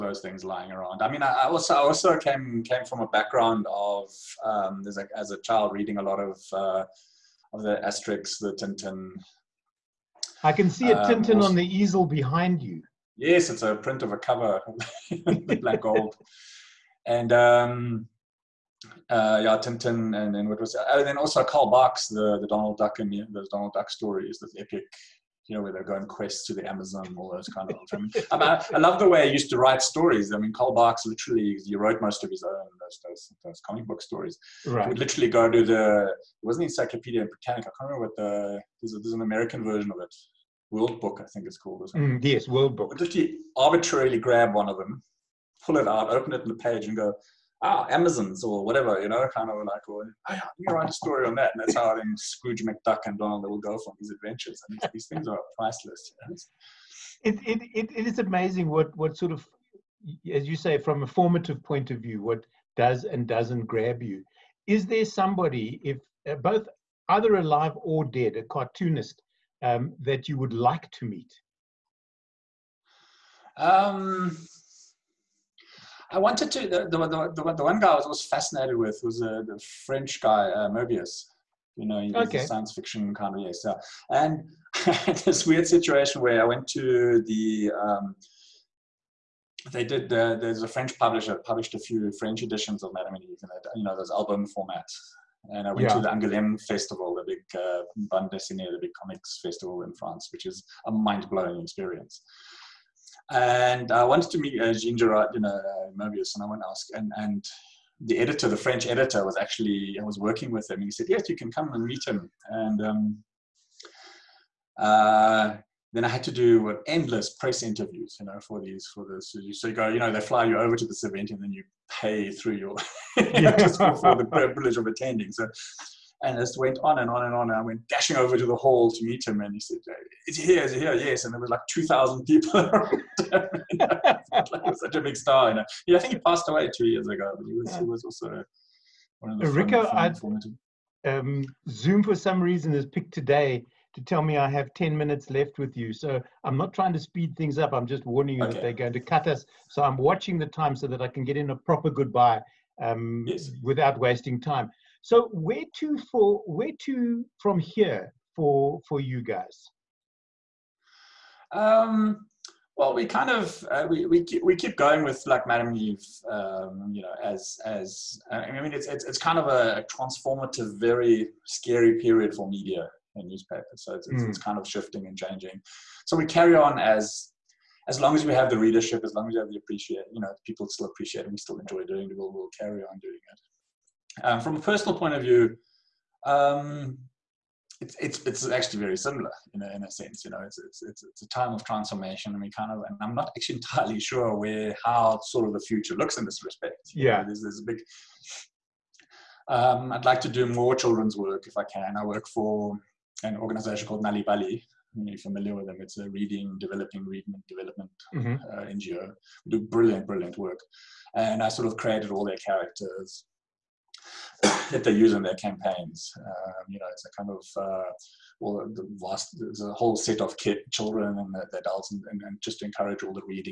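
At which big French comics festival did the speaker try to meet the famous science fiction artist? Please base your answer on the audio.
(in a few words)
Angoulême Festival.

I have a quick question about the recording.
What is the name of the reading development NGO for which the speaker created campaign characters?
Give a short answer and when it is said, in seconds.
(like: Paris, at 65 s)
Nal'ibali, at 204 s.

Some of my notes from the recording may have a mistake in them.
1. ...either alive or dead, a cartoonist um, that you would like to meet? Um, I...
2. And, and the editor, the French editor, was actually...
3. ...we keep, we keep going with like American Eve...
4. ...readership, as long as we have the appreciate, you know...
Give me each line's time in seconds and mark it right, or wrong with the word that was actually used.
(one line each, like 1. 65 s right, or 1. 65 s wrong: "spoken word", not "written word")
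1. 67 s right
2. 106 s right
3. 164 s wrong: "Madam", not "American"
4. 178 s right.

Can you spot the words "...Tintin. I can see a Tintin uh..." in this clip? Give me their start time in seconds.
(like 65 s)
8 s.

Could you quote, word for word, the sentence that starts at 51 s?
And that's how then Scrooge McDuck and Donald will go from these adventures.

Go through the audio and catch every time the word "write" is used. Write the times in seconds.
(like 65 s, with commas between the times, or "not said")
29 s, 50 s.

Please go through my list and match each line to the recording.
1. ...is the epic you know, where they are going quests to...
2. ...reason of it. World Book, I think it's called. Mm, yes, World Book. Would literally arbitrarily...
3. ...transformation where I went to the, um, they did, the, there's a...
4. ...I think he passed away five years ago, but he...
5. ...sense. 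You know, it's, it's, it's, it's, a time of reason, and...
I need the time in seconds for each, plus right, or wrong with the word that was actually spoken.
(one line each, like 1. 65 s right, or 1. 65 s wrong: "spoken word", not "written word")
1. 24 s right
2. 39 s wrong: "version", not "reason"
3. 85 s wrong: "situation", not "transformation"
4. 135 s wrong: "two", not "five"
5. 189 s wrong: "transformation", not "reason".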